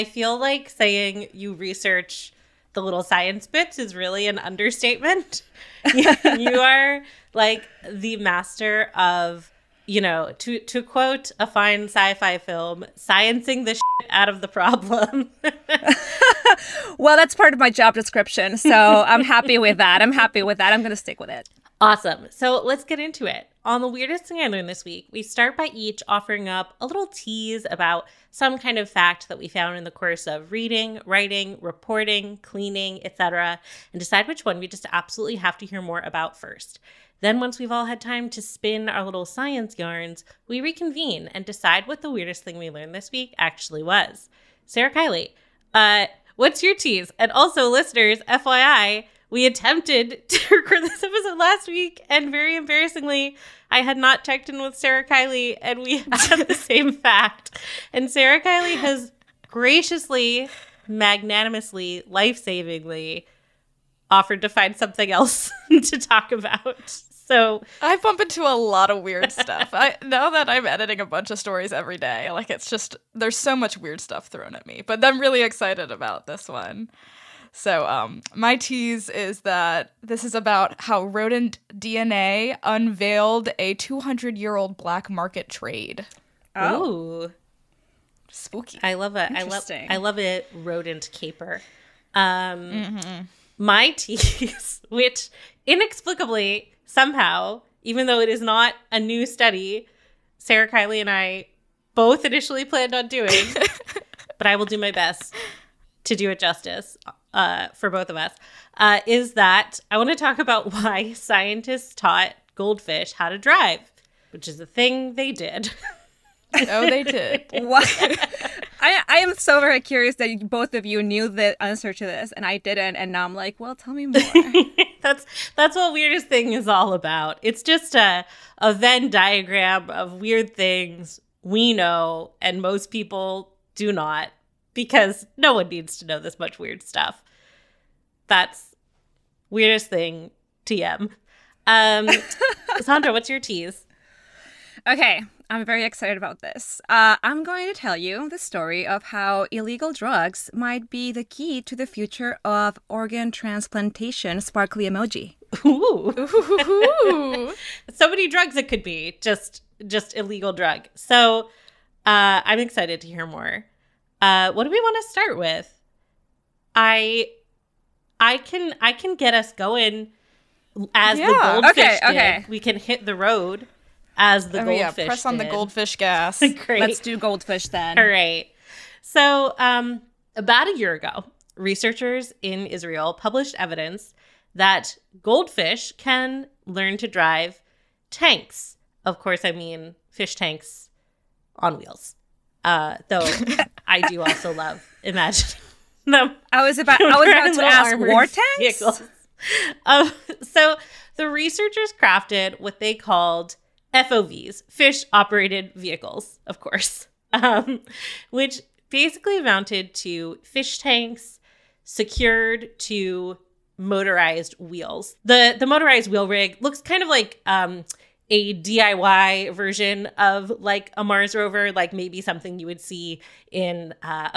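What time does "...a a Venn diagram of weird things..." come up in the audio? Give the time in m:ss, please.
2:07.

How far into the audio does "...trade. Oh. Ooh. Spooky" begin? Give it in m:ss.
1:25.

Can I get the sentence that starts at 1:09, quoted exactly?
I now that I'm editing a bunch of stories every day, like it's just there's so much weird stuff thrown at me.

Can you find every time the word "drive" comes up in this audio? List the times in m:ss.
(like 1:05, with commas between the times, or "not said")
1:53, 3:07.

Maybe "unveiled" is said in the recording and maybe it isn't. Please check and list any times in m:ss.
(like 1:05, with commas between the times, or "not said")
1:22.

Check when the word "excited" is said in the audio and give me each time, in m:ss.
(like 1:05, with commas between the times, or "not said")
1:15, 2:25, 2:42.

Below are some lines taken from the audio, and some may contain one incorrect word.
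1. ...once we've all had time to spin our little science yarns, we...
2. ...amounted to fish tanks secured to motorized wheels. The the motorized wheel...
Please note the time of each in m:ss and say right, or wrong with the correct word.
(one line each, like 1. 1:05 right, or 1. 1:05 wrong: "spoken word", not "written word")
1. 0:37 right
2. 3:29 right.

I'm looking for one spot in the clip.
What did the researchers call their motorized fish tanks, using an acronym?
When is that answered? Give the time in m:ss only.
3:23.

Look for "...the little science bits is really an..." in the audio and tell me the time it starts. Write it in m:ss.
0:02.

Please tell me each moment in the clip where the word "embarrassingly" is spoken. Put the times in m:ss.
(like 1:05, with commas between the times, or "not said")
0:52.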